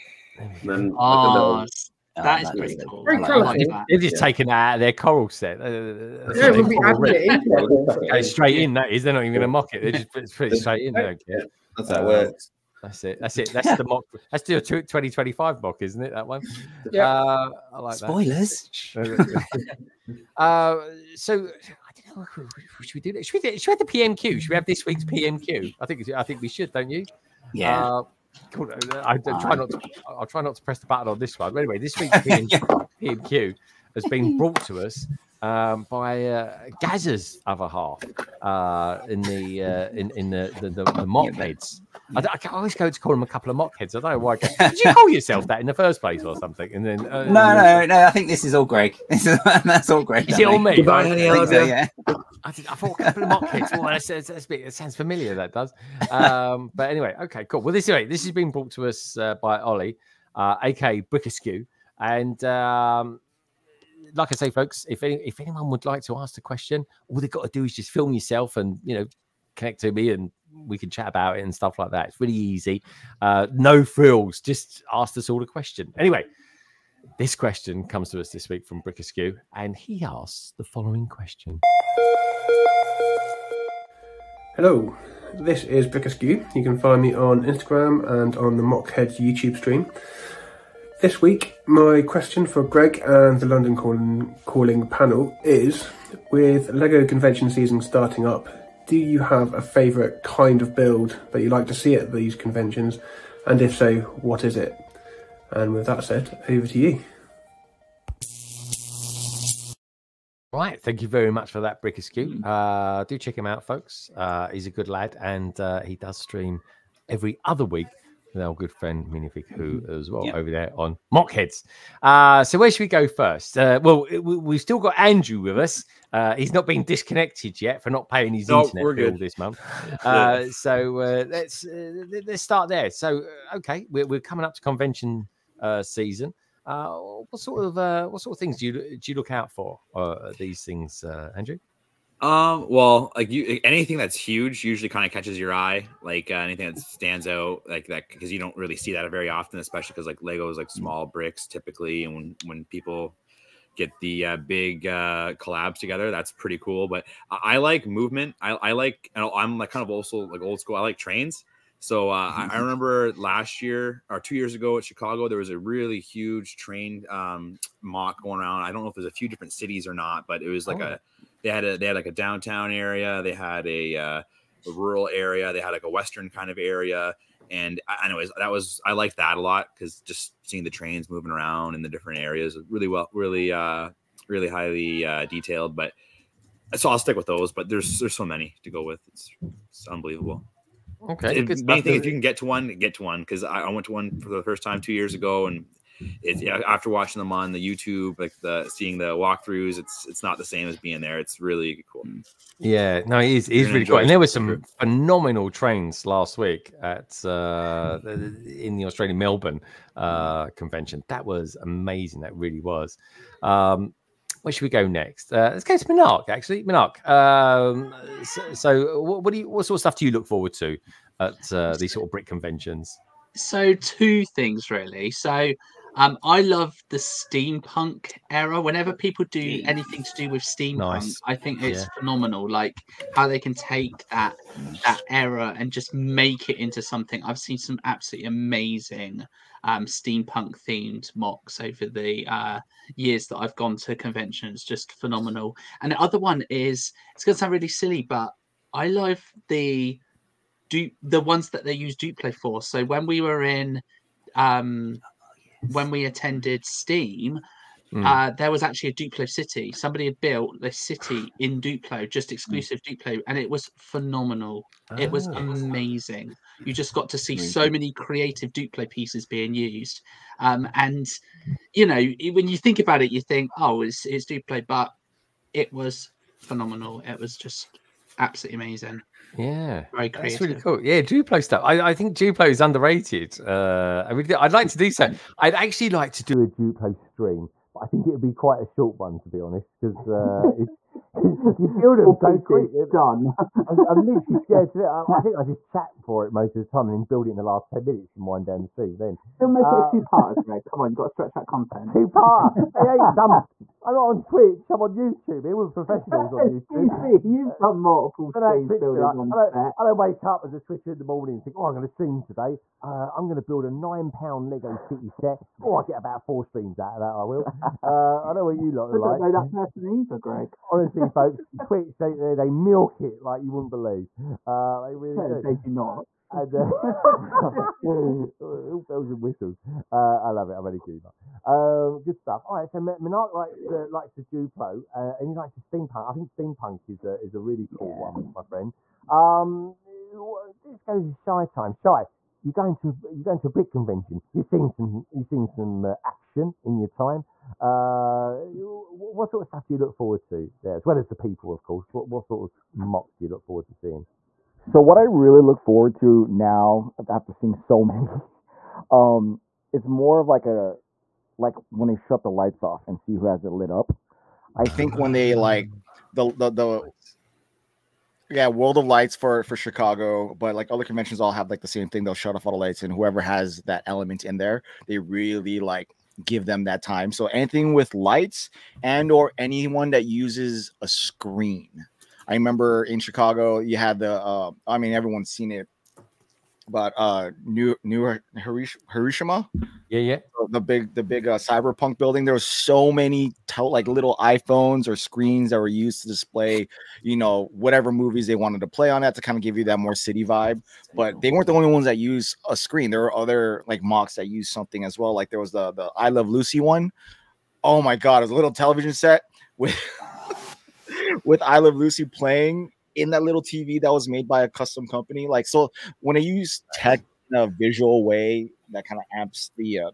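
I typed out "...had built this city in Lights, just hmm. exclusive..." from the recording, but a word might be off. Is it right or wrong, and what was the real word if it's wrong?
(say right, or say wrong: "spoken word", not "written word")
wrong: "Duplo", not "Lights".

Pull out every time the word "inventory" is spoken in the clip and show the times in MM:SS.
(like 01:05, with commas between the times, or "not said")
not said.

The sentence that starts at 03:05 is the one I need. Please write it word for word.
But so I'll stick with those.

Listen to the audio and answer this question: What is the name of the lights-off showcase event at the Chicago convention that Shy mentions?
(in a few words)
World of Lights.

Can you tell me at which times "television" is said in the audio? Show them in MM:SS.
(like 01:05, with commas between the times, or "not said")
06:48.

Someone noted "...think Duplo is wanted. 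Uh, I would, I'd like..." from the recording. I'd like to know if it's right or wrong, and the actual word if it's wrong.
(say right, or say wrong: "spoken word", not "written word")
wrong: "underrated", not "wanted".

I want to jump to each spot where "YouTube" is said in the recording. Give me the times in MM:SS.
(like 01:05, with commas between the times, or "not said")
01:29, 03:17, 05:04.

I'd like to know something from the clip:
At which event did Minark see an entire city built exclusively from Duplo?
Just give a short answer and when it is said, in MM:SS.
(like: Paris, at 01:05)
Steam, at 04:16.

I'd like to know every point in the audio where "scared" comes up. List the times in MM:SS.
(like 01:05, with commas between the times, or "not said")
04:54.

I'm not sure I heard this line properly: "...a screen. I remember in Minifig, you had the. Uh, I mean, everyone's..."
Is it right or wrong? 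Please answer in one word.
wrong.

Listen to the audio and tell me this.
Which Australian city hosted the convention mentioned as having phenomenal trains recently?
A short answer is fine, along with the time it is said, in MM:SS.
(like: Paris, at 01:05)
Melbourne, at 03:29.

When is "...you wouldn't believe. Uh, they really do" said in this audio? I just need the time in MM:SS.
05:23.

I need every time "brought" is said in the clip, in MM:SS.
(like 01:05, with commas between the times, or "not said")
00:34, 00:58.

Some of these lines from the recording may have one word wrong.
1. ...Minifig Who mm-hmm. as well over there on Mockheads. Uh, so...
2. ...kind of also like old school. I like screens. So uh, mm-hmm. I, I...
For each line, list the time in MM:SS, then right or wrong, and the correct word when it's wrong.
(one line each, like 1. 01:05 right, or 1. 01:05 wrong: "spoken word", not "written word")
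1. 01:59 right
2. 02:39 wrong: "trains", not "screens".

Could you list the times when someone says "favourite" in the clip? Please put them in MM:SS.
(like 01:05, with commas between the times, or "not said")
01:39.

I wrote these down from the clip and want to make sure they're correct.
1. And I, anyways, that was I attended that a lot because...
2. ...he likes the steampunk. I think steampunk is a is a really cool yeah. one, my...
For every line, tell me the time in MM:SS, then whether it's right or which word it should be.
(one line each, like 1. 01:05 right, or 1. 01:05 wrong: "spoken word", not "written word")
1. 02:57 wrong: "liked", not "attended"
2. 05:35 right.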